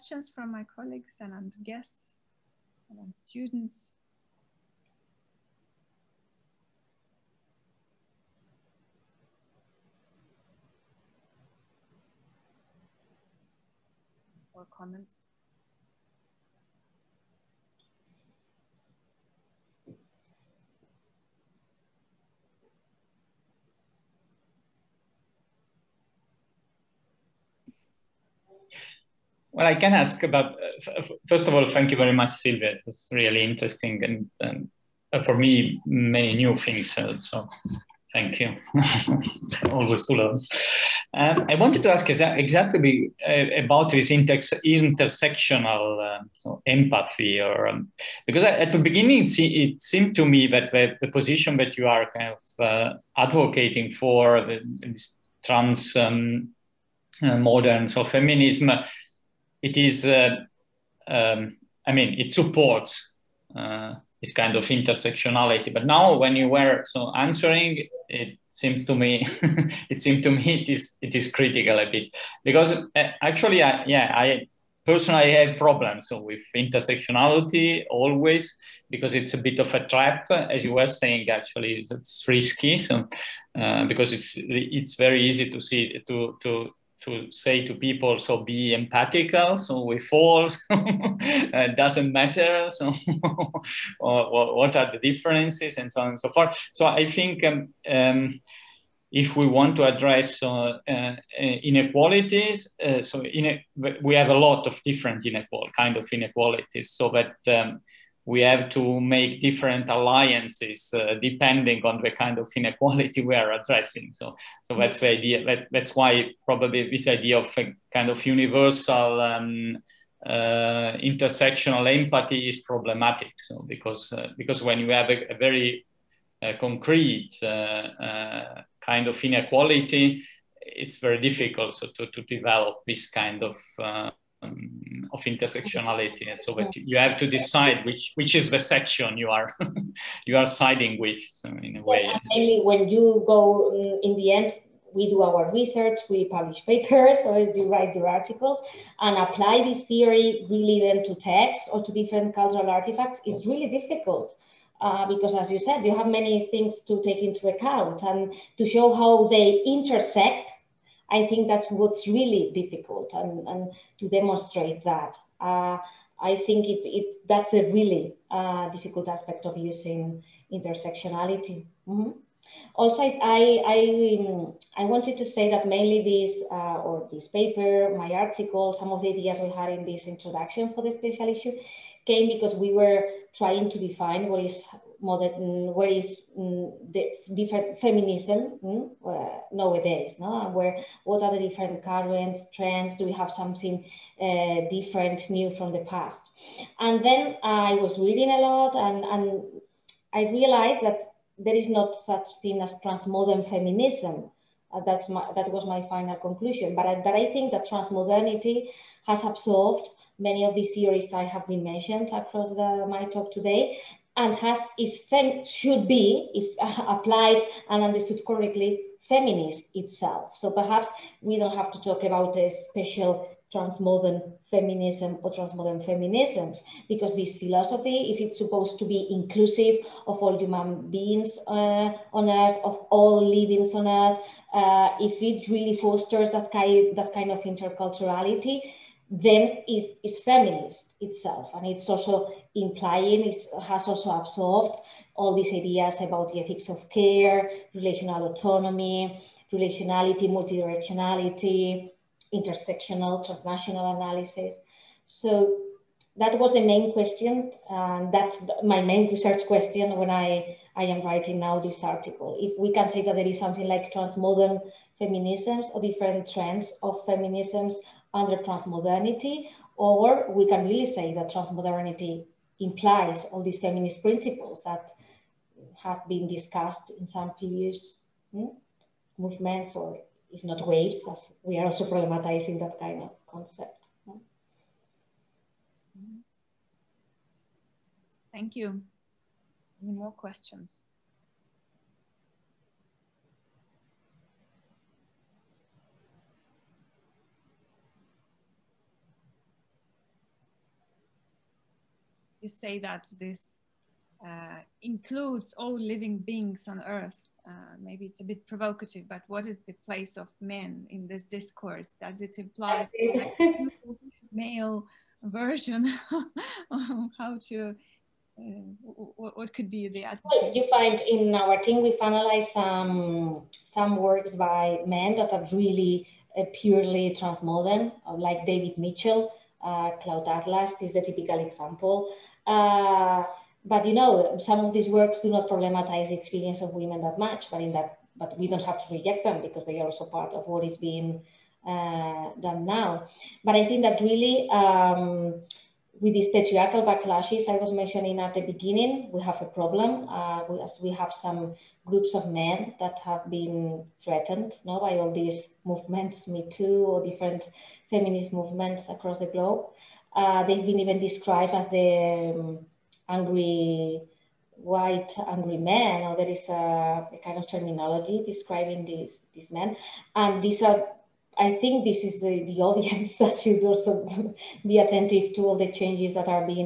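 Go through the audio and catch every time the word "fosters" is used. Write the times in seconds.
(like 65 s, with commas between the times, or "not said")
235 s.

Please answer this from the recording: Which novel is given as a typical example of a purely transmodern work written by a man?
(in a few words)
Cloud Atlas.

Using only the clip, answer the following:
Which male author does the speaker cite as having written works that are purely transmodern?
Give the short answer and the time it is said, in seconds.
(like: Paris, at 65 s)
David Mitchell, at 328 s.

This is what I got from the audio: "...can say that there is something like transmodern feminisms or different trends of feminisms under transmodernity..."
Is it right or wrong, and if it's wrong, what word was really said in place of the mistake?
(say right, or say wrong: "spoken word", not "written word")
right.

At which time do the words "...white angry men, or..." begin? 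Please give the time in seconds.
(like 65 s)
364 s.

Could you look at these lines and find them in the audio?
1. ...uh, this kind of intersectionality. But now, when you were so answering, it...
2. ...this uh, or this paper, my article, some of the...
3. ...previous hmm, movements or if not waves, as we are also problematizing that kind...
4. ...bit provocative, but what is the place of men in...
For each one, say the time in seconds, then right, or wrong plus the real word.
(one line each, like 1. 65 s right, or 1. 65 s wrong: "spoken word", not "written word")
1. 63 s right
2. 176 s right
3. 277 s right
4. 308 s right.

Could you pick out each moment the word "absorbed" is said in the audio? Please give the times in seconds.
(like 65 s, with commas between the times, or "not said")
209 s, 244 s.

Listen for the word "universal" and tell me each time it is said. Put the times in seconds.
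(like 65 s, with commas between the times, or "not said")
118 s.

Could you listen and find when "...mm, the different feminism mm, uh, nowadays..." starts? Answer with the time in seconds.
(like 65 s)
186 s.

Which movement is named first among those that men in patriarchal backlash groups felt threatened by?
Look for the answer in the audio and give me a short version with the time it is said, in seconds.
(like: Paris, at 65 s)
Me Too, at 356 s.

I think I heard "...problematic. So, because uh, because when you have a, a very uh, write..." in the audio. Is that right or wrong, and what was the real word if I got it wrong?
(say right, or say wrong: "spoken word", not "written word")
wrong: "concrete", not "write".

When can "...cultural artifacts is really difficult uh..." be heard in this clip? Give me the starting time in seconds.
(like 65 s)
152 s.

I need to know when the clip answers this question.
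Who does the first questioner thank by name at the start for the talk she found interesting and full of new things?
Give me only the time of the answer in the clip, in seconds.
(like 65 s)
32 s.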